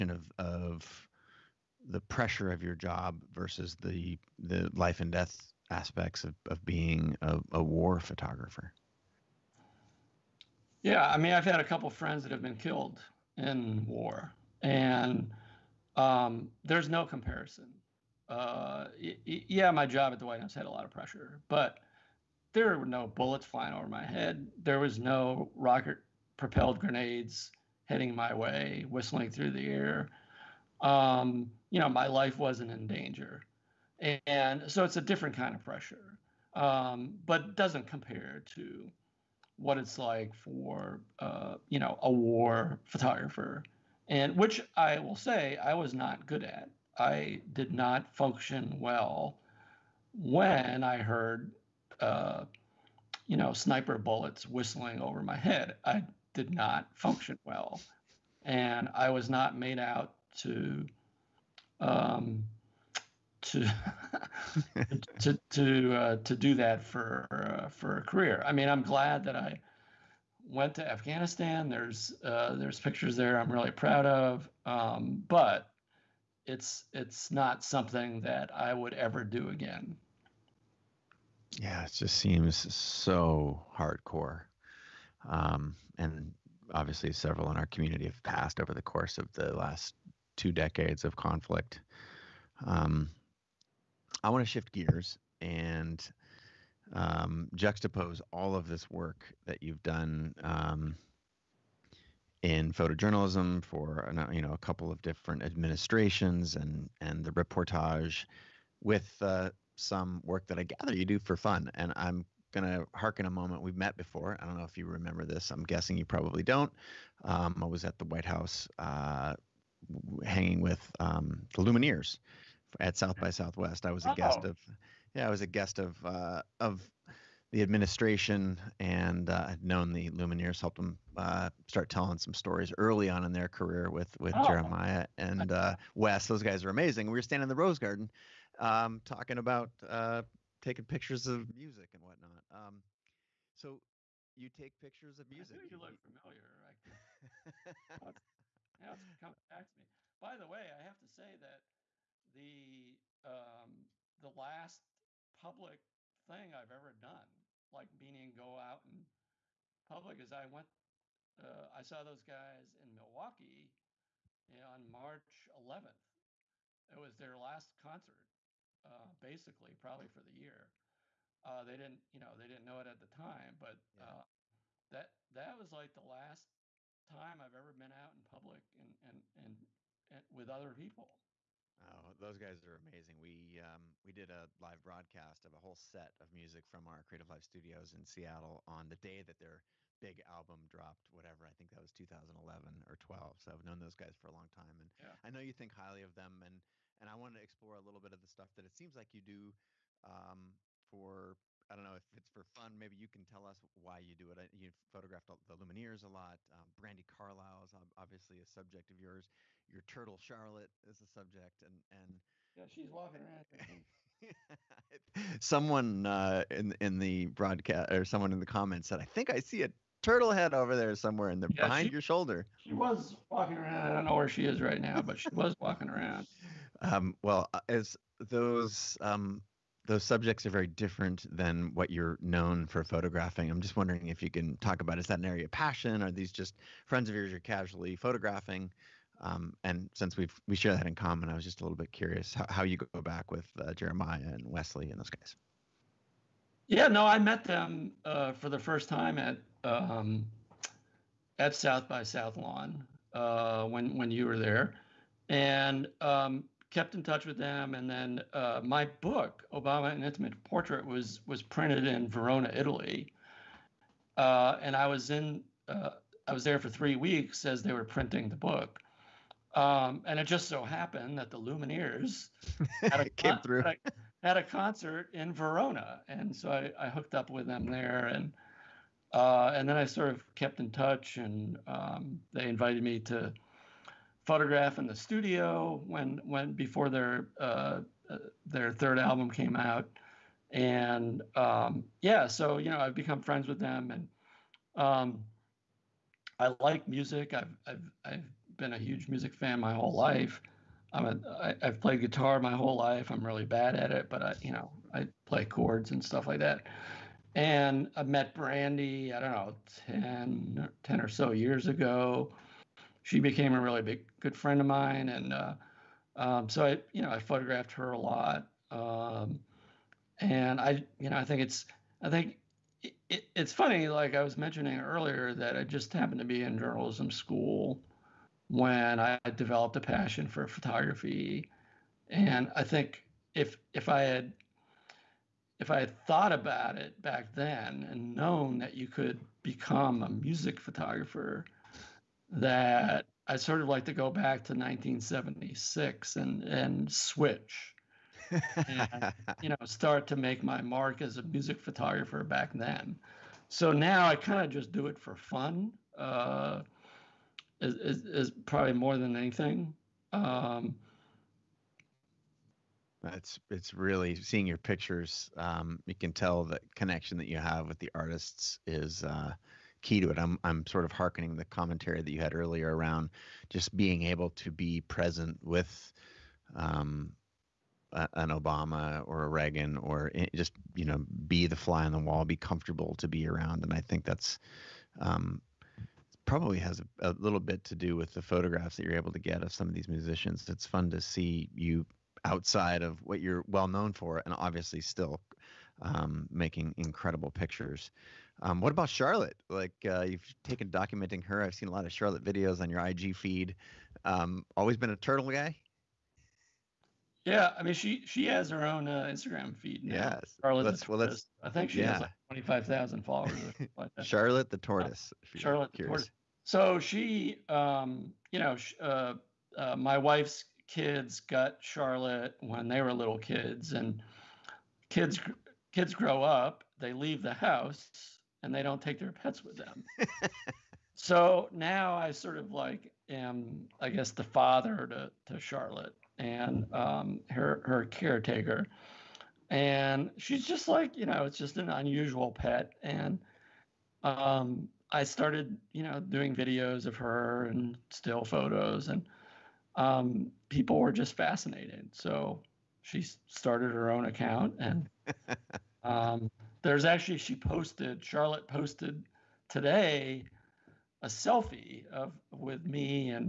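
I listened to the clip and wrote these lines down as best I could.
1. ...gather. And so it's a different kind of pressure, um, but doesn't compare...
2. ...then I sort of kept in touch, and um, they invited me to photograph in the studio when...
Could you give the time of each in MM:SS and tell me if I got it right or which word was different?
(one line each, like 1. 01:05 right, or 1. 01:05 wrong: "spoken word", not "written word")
1. 00:32 wrong: "danger", not "gather"
2. 04:39 right.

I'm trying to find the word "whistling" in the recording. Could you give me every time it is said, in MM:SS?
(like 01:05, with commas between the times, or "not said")
00:28, 00:54.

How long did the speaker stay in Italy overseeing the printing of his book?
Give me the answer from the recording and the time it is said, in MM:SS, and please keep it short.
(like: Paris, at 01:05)
3 weeks, at 04:26.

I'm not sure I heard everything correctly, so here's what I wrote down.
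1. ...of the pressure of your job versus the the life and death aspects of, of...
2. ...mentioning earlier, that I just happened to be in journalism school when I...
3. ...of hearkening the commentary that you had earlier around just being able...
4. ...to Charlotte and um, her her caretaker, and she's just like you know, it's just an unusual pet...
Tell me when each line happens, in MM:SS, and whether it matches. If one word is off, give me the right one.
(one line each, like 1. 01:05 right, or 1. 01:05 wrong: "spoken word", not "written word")
1. 00:00 right
2. 05:24 right
3. 06:10 right
4. 07:15 right.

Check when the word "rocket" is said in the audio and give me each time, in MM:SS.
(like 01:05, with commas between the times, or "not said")
00:25.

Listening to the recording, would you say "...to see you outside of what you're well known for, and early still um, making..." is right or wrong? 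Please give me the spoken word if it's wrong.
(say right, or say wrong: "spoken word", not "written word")
wrong: "obviously", not "early".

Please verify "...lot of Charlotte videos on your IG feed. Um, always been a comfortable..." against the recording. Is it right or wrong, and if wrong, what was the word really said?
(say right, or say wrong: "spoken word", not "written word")
wrong: "turtle", not "comfortable".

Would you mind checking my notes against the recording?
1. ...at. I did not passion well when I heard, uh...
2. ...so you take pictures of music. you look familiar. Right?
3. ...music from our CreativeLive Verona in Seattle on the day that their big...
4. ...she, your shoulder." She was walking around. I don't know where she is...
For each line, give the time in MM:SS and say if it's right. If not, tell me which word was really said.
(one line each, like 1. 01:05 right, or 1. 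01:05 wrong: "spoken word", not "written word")
1. 00:46 wrong: "function", not "passion"
2. 02:23 right
3. 03:06 wrong: "Studios", not "Verona"
4. 03:41 right.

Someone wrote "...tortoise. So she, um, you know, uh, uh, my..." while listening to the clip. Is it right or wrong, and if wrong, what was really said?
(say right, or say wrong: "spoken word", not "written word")
right.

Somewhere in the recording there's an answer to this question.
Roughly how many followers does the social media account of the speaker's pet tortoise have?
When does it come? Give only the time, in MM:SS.
06:52.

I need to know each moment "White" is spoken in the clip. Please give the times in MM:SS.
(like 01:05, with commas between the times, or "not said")
00:20, 01:58.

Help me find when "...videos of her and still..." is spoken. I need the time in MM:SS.
07:26.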